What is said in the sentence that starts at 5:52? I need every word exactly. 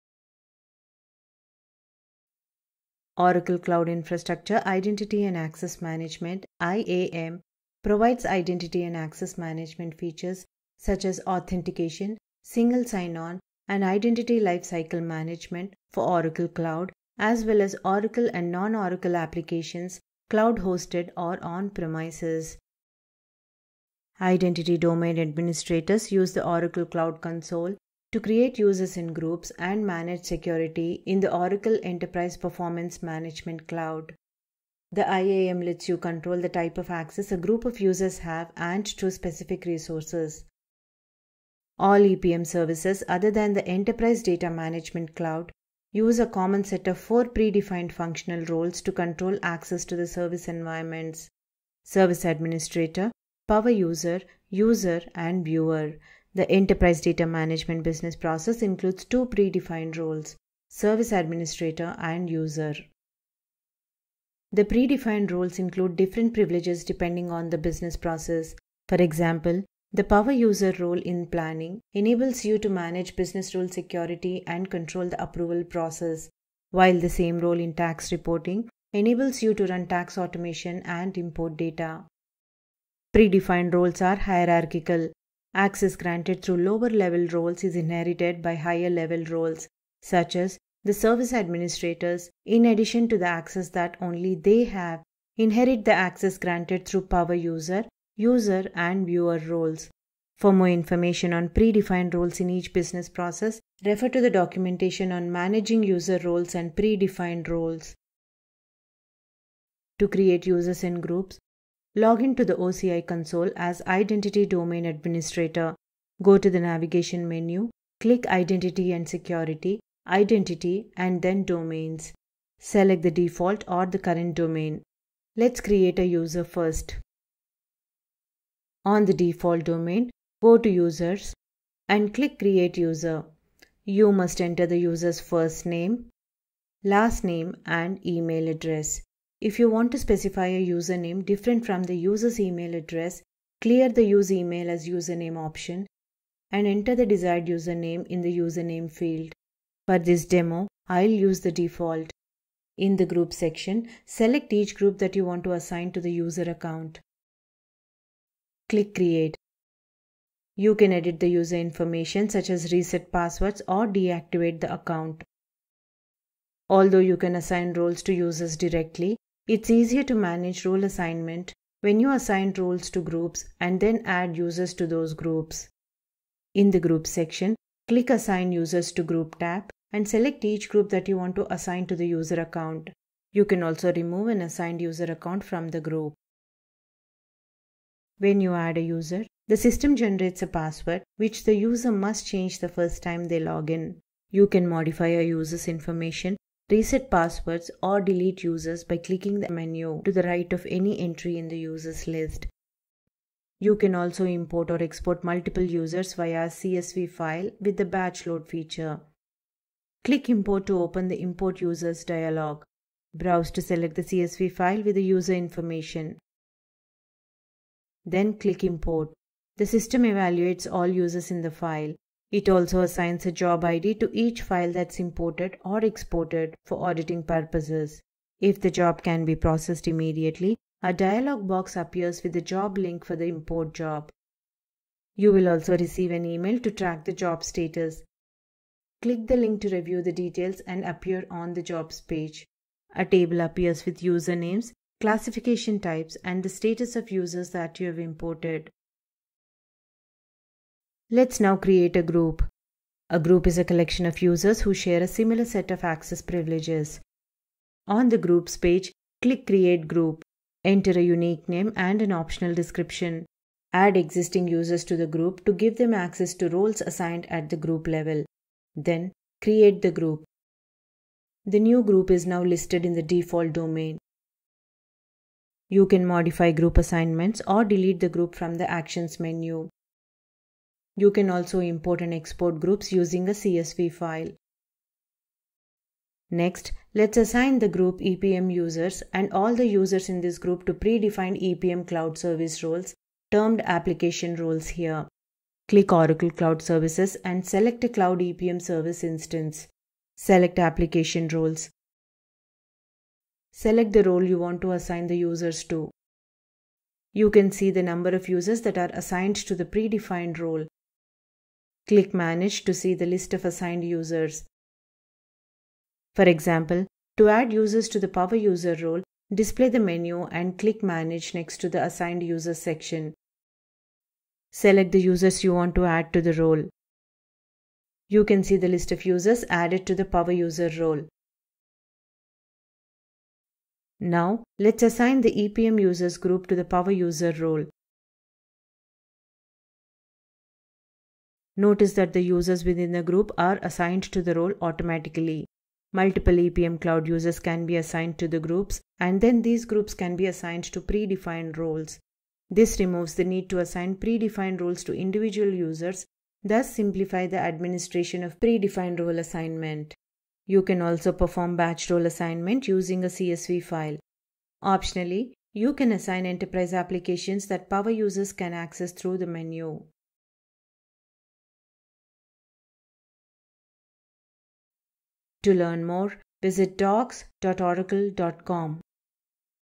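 This removes the need to assign predefined roles to individual users, thus simplify the administration of predefined role assignment.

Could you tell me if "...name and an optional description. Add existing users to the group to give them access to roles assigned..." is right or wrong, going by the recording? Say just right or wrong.
right.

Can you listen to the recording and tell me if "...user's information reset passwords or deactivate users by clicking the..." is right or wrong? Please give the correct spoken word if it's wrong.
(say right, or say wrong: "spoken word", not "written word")
wrong: "delete", not "deactivate".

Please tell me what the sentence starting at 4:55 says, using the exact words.
Click Oracle Cloud Services and select a Cloud EPM service instance.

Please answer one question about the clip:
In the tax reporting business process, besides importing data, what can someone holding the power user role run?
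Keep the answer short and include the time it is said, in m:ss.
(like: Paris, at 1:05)
tax automation, at 1:19.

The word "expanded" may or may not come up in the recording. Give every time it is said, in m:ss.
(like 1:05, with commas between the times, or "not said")
not said.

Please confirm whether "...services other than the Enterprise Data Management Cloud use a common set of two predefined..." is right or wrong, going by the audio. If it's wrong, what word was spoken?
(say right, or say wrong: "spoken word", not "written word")
wrong: "four", not "two".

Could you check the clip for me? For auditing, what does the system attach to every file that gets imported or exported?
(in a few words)
job ID.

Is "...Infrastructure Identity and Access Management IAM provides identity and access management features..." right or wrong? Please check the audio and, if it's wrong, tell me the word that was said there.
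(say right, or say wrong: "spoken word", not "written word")
right.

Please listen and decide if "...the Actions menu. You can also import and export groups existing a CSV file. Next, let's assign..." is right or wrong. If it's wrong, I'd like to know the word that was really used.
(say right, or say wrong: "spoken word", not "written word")
wrong: "using", not "existing".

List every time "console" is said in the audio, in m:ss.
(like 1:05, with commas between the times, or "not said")
0:27, 1:53.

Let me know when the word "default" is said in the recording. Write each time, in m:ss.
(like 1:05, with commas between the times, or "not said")
2:03, 2:09, 2:31, 4:33.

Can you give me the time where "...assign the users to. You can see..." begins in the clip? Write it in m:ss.
5:04.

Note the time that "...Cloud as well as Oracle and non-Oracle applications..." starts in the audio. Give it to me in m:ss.
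0:16.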